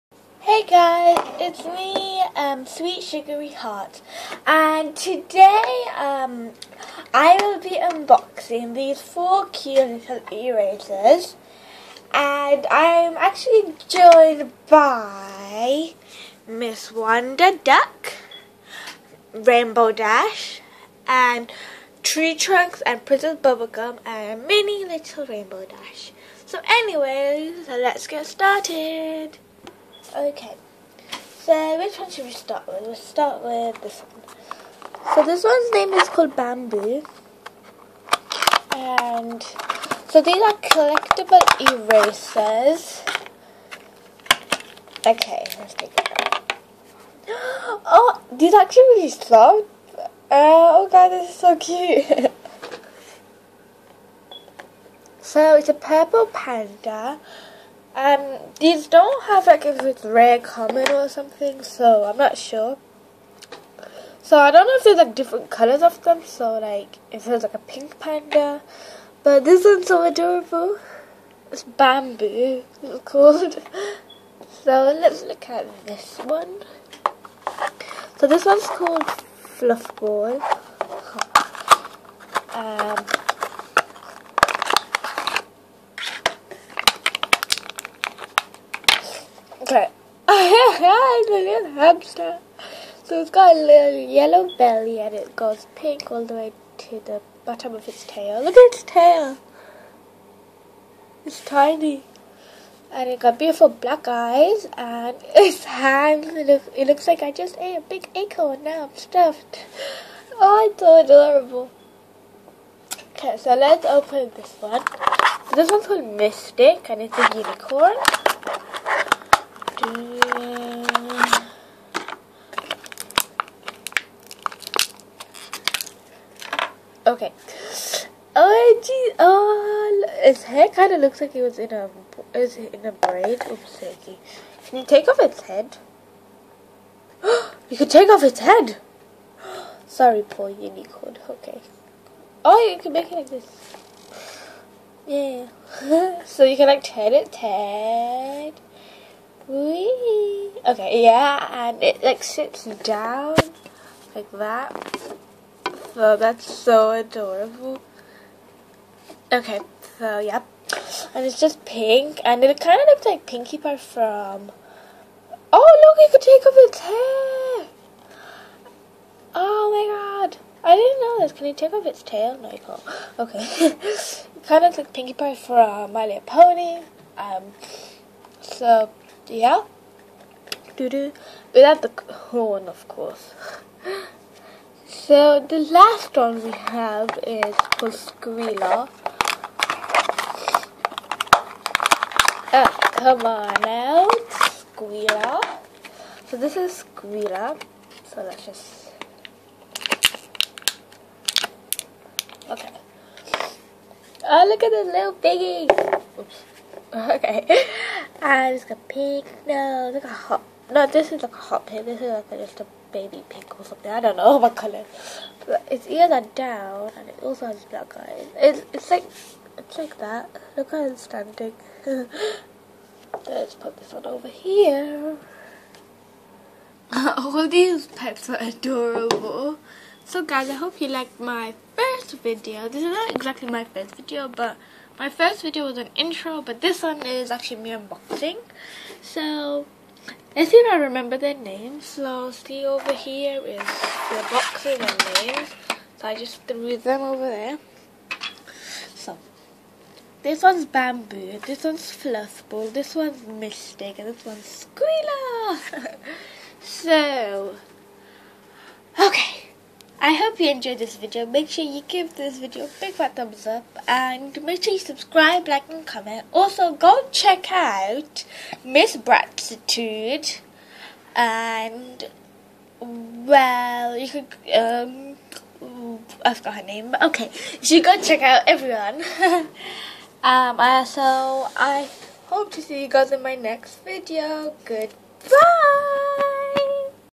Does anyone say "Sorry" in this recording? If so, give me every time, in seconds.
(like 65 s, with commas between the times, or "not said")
139 s.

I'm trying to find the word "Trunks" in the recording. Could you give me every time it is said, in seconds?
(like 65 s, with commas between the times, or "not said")
22 s.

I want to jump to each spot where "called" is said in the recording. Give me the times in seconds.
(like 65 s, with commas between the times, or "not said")
36 s, 73 s, 78 s, 115 s.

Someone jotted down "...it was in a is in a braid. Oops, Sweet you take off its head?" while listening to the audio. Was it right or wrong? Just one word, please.
wrong.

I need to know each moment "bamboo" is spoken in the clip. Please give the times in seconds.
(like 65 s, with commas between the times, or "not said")
36 s, 71 s, 250 s.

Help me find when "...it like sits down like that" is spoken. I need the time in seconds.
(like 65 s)
151 s.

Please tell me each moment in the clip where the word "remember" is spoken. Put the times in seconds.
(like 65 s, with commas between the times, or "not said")
240 s.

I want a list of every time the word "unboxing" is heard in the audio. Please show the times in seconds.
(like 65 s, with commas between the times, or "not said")
7 s, 237 s.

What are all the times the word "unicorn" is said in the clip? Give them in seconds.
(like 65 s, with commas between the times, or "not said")
117 s, 140 s.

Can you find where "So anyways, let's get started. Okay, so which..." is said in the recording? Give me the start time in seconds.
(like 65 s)
26 s.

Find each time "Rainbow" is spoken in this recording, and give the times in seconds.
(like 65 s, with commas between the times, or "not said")
19 s, 25 s.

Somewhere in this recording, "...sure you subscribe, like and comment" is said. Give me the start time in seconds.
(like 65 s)
264 s.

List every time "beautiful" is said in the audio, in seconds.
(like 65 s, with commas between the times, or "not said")
103 s.